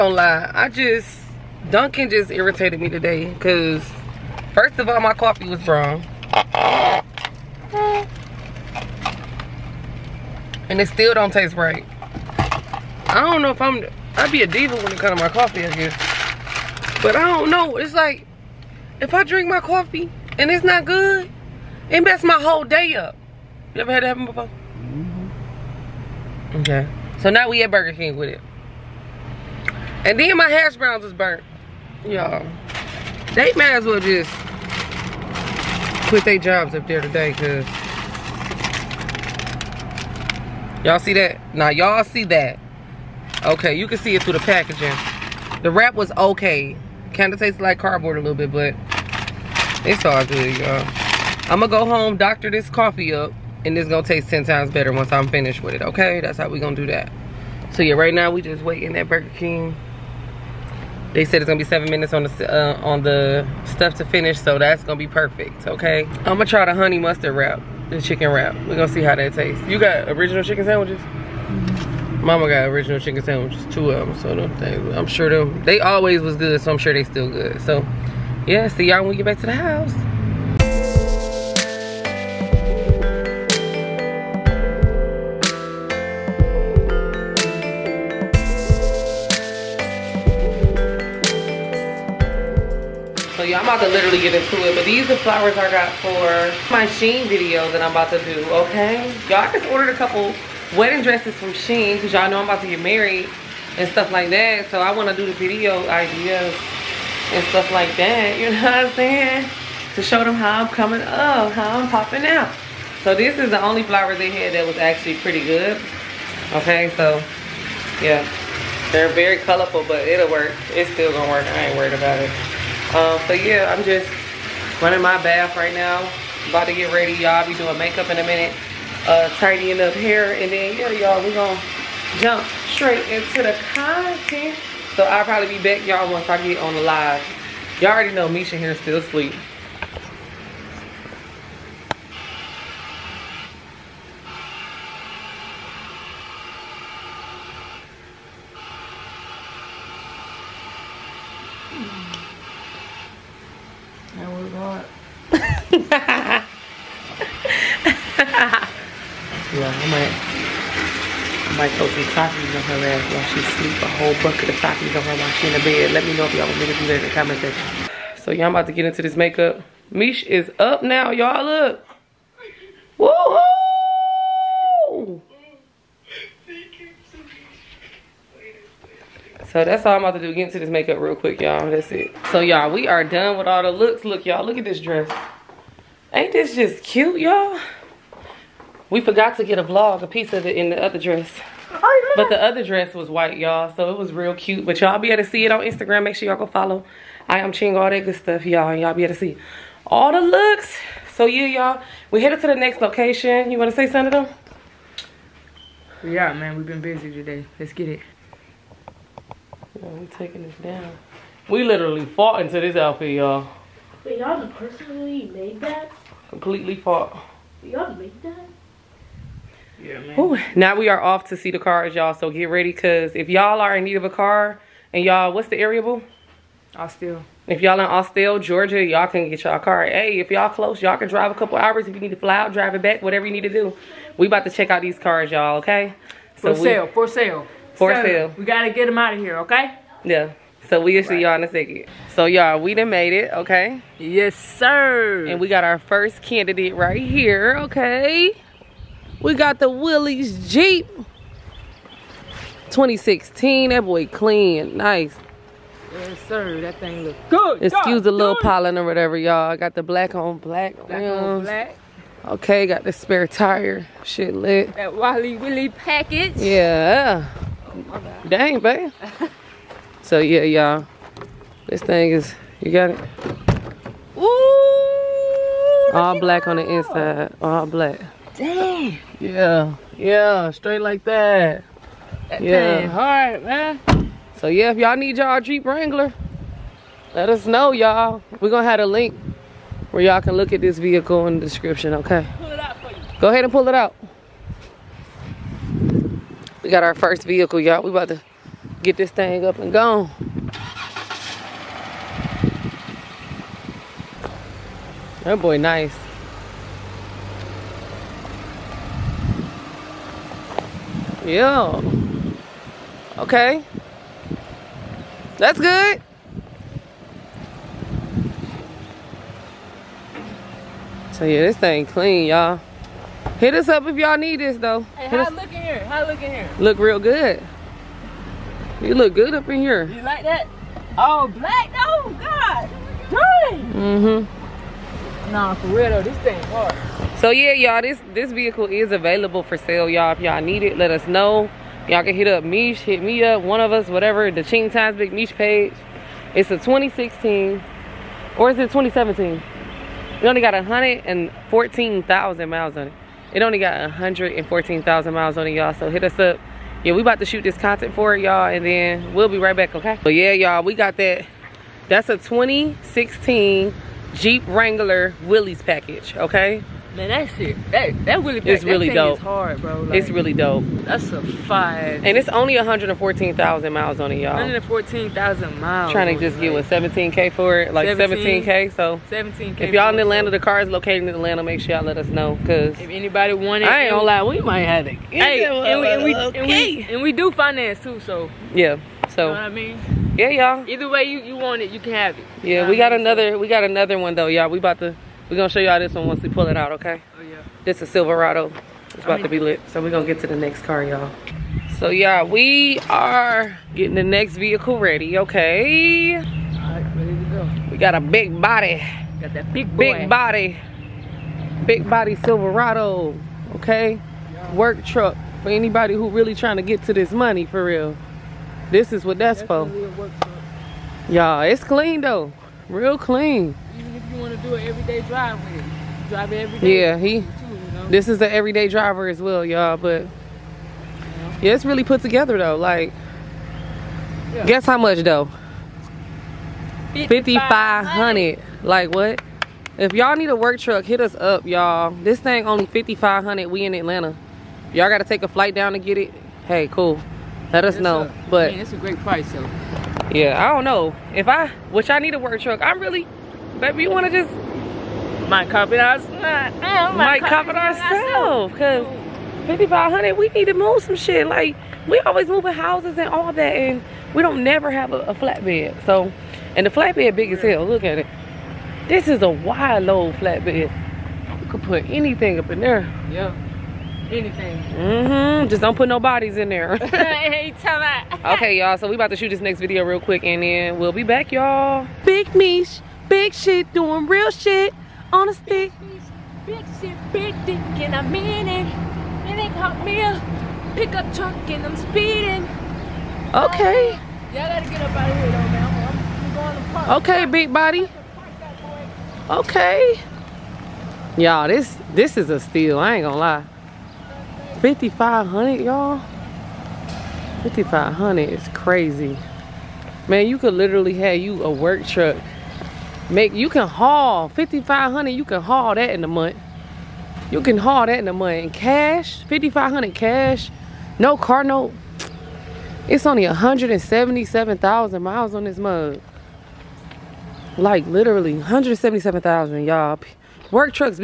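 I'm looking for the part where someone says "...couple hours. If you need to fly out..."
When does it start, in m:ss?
3:51.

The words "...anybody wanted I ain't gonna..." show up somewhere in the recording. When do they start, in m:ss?
6:22.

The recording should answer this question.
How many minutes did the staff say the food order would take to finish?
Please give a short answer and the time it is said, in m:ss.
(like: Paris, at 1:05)
7, at 1:01.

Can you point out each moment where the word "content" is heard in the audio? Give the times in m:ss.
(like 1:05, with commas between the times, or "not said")
2:13, 5:57.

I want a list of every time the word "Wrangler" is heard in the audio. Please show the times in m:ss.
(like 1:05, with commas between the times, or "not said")
4:45, 6:04.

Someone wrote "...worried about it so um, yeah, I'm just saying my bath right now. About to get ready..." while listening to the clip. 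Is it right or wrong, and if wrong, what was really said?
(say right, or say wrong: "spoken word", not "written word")
wrong: "running", not "saying".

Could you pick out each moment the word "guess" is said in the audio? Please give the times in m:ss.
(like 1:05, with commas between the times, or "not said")
0:15, 7:14.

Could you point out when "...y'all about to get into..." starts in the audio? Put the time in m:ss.
2:48.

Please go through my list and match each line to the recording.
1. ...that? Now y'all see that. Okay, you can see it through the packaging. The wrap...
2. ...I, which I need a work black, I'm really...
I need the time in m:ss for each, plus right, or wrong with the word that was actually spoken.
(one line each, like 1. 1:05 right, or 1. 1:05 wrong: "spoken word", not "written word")
1. 0:41 right
2. 7:31 wrong: "truck", not "black".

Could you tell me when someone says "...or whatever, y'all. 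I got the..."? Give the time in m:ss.
4:18.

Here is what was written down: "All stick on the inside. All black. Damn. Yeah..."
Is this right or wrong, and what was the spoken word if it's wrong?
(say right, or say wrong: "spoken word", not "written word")
wrong: "black", not "stick".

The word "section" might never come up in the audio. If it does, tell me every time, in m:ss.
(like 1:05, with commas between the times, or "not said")
2:47.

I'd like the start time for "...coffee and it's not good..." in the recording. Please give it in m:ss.
0:19.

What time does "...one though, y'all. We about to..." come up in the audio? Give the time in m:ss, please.
6:33.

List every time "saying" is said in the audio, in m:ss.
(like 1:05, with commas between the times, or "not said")
1:48.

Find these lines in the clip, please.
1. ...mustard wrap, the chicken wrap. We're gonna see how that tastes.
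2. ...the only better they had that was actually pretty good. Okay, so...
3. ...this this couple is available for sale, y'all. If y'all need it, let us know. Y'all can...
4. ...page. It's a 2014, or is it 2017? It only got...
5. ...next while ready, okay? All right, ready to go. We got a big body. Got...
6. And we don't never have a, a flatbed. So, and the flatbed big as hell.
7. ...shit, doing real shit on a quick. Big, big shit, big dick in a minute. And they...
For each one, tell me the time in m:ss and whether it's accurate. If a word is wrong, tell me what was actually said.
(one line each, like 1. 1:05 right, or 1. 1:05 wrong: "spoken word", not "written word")
1. 1:06 right
2. 1:53 wrong: "flower", not "better"
3. 5:37 wrong: "vehicle", not "couple"
4. 5:45 wrong: "2016", not "2014"
5. 6:44 wrong: "vehicle", not "while"
6. 7:43 right
7. 8:03 wrong: "stick", not "quick".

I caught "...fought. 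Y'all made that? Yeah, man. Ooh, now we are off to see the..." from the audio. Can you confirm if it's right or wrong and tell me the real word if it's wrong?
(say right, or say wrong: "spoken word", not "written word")
right.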